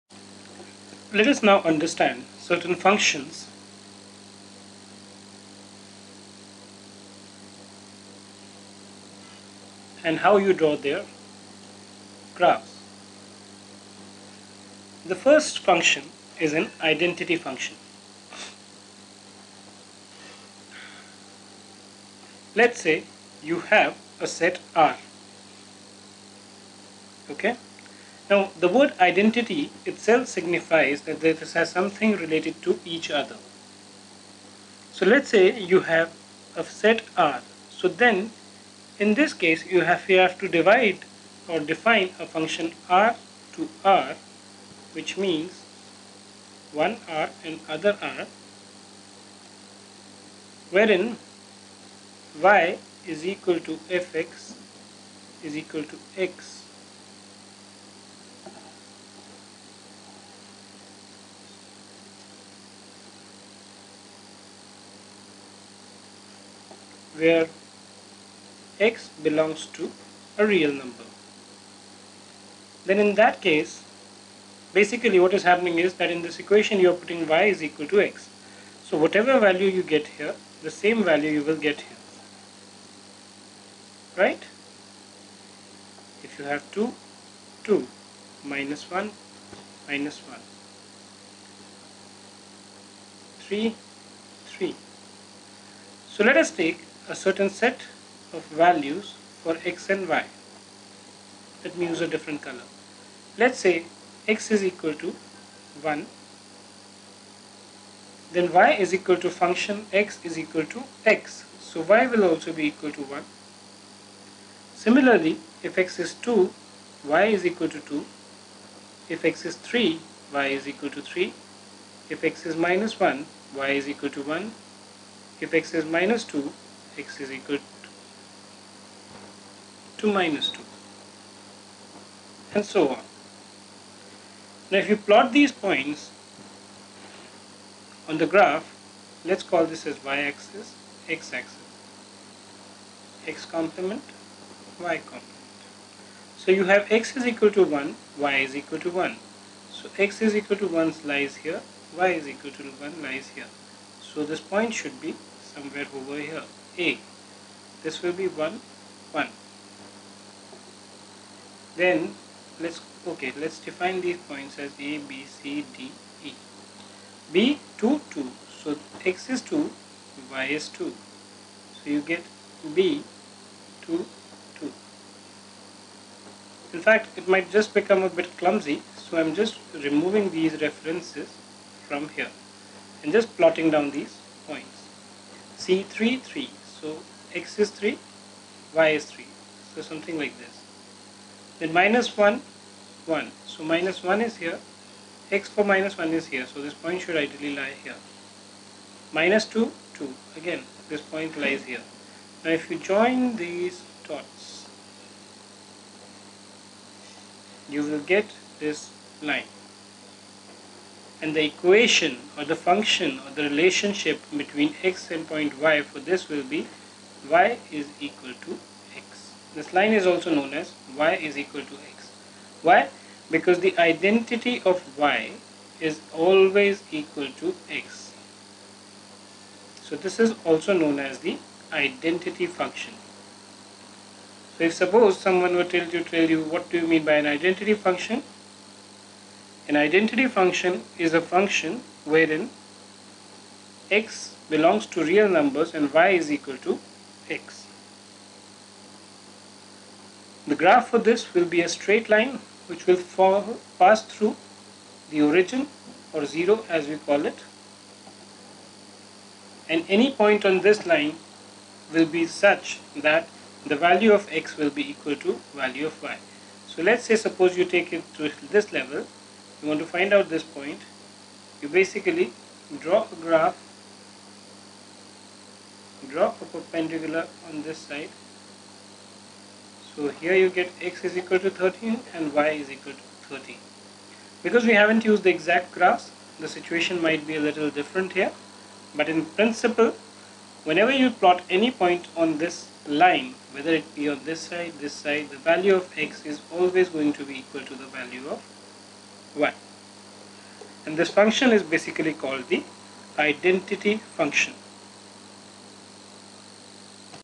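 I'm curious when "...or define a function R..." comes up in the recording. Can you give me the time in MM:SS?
00:41.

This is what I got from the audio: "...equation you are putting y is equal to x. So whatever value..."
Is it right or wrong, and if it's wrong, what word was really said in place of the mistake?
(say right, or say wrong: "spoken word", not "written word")
right.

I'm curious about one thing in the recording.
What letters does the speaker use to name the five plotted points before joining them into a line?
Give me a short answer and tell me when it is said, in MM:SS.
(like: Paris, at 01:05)
A, B, C, D, E, at 02:44.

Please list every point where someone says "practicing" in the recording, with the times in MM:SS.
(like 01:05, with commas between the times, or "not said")
not said.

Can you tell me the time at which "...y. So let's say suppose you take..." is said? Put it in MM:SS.
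04:26.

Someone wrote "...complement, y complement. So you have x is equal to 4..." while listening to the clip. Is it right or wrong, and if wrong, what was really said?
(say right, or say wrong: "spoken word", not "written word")
wrong: "1", not "4".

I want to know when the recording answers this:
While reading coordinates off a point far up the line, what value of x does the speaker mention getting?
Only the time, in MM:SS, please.
04:40.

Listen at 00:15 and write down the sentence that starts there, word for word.
The first function is an identity function.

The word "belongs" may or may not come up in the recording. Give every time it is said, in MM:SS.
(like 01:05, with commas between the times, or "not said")
01:09, 04:04.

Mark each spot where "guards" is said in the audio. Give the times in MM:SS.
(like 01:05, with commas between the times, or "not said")
not said.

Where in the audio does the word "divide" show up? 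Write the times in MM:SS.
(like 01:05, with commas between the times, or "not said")
00:40.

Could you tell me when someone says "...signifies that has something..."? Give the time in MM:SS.
00:30.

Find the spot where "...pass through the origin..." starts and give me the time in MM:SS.
04:13.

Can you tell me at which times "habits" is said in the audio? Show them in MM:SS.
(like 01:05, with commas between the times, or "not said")
not said.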